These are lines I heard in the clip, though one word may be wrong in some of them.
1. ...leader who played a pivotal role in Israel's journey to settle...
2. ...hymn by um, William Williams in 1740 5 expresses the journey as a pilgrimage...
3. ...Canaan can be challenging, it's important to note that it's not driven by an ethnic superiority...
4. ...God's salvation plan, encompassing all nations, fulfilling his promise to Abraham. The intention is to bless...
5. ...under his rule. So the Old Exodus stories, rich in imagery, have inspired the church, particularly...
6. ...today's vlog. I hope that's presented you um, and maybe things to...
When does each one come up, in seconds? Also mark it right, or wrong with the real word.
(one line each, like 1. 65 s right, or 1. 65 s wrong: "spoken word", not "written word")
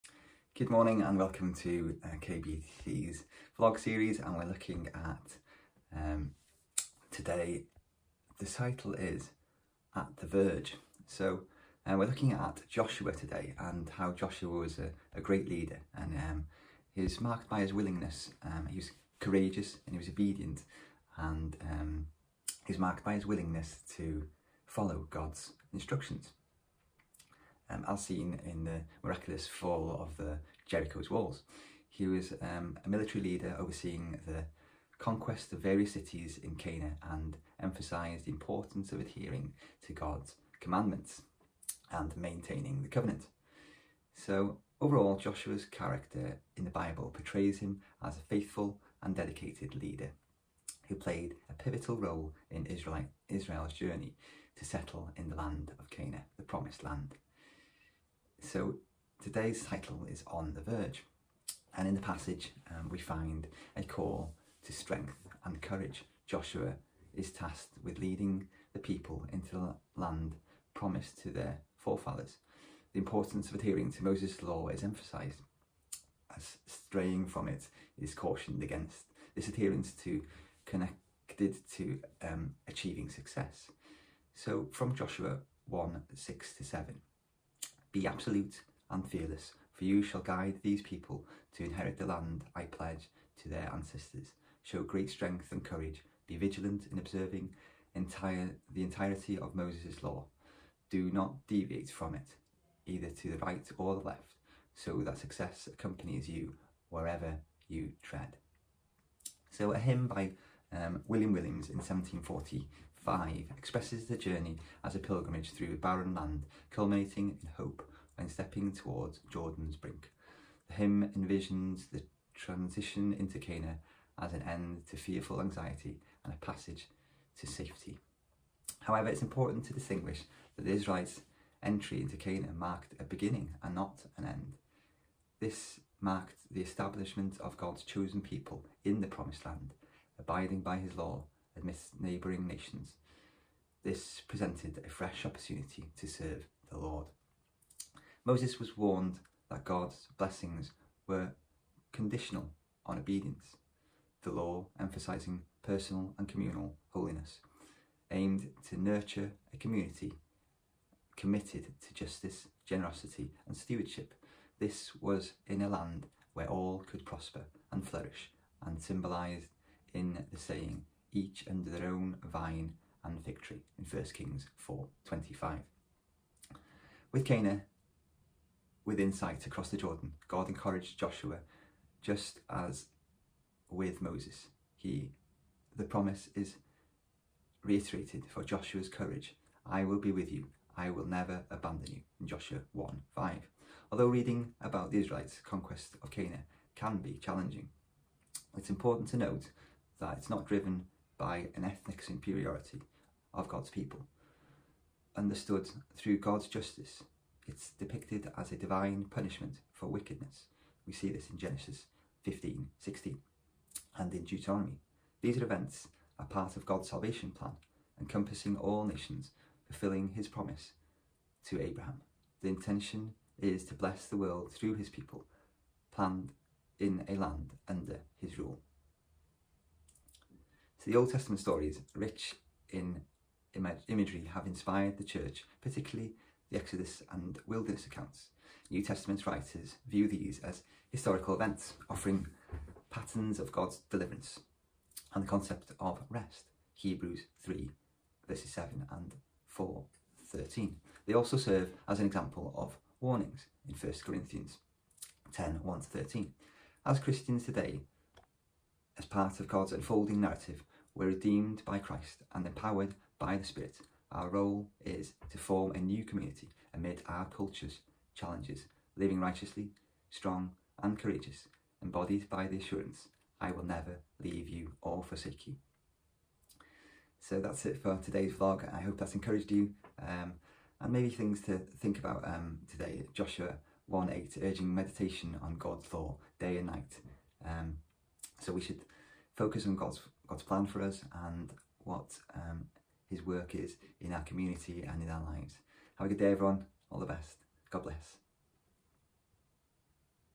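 1. 49 s right
2. 109 s right
3. 196 s right
4. 216 s right
5. 227 s wrong: "Testament", not "Exodus"
6. 277 s wrong: "encouraged", not "presented".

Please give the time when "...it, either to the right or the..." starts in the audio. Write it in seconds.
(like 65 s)
102 s.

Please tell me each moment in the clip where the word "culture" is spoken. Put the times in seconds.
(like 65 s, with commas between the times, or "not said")
267 s.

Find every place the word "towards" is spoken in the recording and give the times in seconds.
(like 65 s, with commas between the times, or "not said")
118 s.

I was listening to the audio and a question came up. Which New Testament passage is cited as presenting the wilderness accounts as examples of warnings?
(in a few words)
1 Corinthians 10:1-13.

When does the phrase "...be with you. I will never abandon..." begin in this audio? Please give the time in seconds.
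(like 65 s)
189 s.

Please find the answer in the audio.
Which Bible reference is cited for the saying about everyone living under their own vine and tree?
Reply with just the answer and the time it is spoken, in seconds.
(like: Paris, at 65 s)
1 Kings 4:25, at 173 s.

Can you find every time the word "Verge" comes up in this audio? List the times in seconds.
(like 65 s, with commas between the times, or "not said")
10 s, 60 s.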